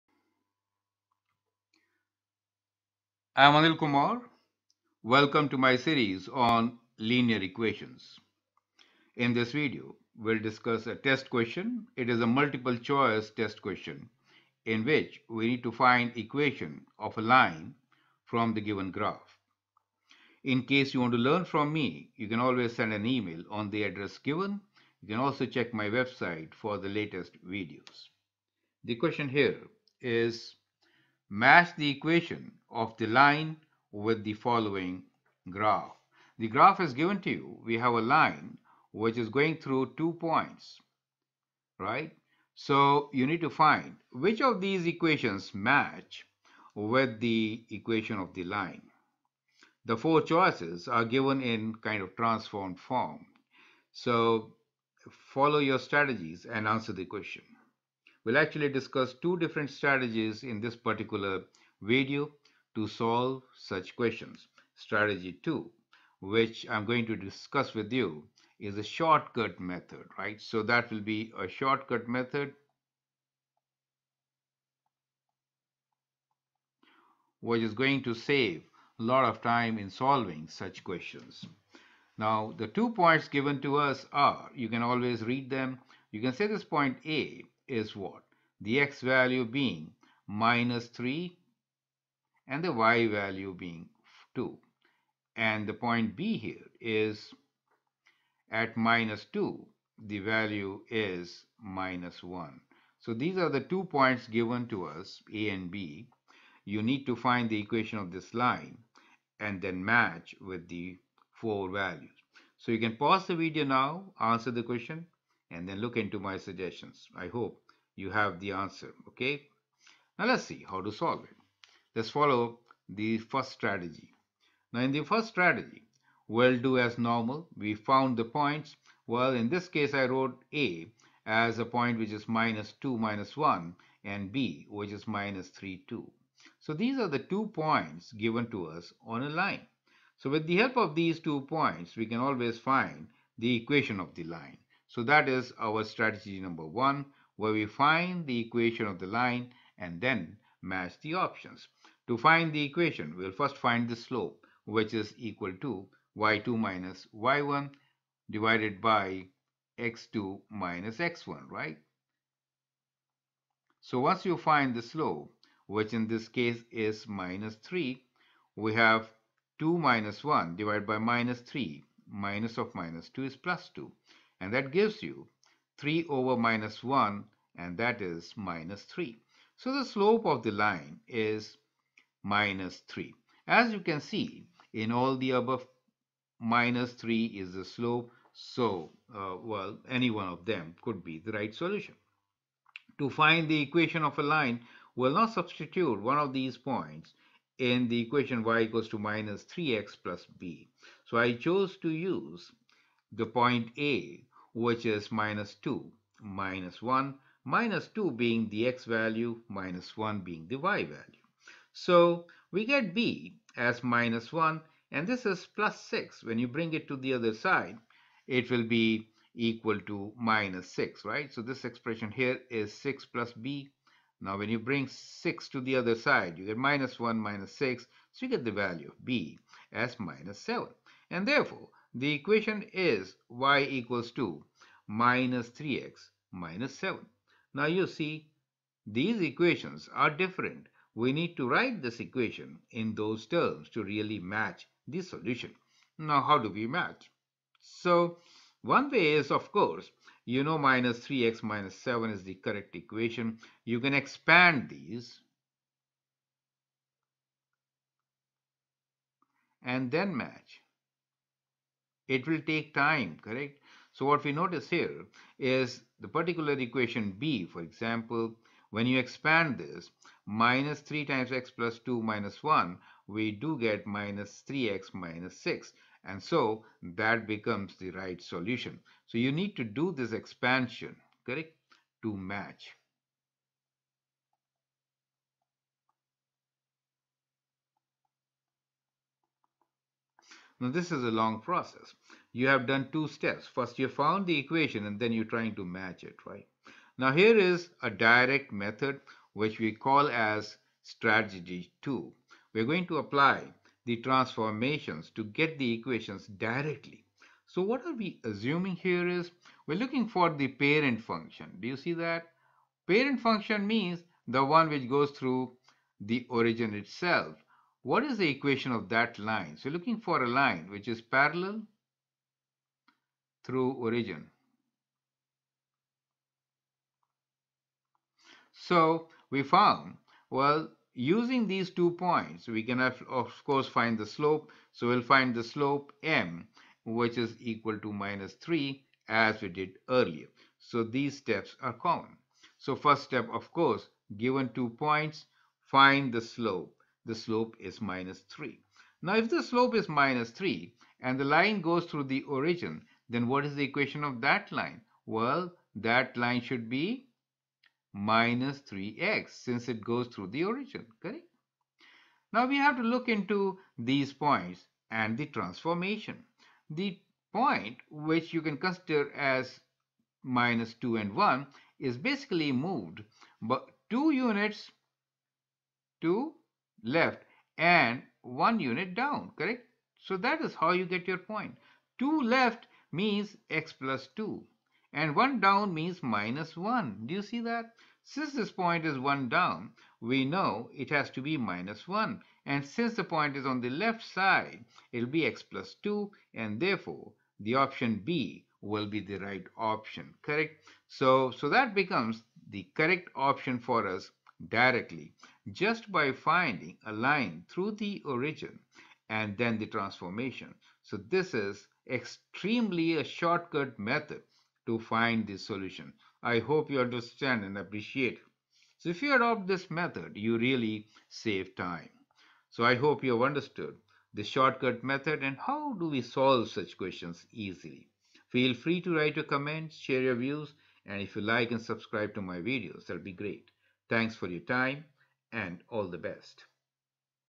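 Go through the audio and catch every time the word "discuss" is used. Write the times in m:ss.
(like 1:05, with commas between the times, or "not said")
0:10, 0:58, 1:07.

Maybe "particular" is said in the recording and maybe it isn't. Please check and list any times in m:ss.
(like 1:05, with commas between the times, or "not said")
1:00, 4:26.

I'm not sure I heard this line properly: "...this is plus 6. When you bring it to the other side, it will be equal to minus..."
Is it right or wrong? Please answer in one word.
right.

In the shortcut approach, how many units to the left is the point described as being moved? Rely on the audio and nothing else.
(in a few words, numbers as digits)
2.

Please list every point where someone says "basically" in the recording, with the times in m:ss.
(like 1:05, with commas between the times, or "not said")
6:11.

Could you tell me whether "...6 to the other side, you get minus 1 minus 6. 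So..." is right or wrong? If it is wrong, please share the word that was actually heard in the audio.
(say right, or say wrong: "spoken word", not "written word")
right.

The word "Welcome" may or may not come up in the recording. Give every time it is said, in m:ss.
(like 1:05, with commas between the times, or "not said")
0:05.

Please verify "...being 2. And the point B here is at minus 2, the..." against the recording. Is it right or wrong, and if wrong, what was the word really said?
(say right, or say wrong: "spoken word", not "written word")
right.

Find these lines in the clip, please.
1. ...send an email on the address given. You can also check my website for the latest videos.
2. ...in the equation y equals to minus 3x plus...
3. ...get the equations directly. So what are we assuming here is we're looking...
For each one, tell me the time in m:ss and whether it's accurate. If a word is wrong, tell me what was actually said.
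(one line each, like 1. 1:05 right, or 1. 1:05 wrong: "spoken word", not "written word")
1. 0:22 right
2. 3:17 right
3. 5:05 right.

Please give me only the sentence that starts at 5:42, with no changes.
So first step, of course, given two points, find the slope the slope is minus 3.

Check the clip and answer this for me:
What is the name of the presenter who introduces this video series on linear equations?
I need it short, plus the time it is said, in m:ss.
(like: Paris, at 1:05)
Anil Kumar, at 0:03.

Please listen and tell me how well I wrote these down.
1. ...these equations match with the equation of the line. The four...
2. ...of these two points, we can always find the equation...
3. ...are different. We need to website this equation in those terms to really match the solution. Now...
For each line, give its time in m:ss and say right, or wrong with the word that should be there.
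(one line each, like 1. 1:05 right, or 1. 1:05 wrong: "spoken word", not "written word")
1. 0:44 right
2. 2:20 right
3. 3:59 wrong: "write", not "website".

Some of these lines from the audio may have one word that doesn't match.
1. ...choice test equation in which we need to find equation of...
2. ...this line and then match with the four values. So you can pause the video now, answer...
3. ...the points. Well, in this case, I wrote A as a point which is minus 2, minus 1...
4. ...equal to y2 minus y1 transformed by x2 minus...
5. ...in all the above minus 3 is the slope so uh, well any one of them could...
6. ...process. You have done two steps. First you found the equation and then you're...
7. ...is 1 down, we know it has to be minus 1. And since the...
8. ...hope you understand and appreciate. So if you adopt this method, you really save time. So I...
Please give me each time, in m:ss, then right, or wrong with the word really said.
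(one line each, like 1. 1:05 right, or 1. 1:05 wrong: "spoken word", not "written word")
1. 0:12 wrong: "question", not "equation"
2. 1:48 right
3. 2:08 right
4. 2:35 wrong: "divided", not "transformed"
5. 3:04 right
6. 4:51 right
7. 6:28 right
8. 6:56 right.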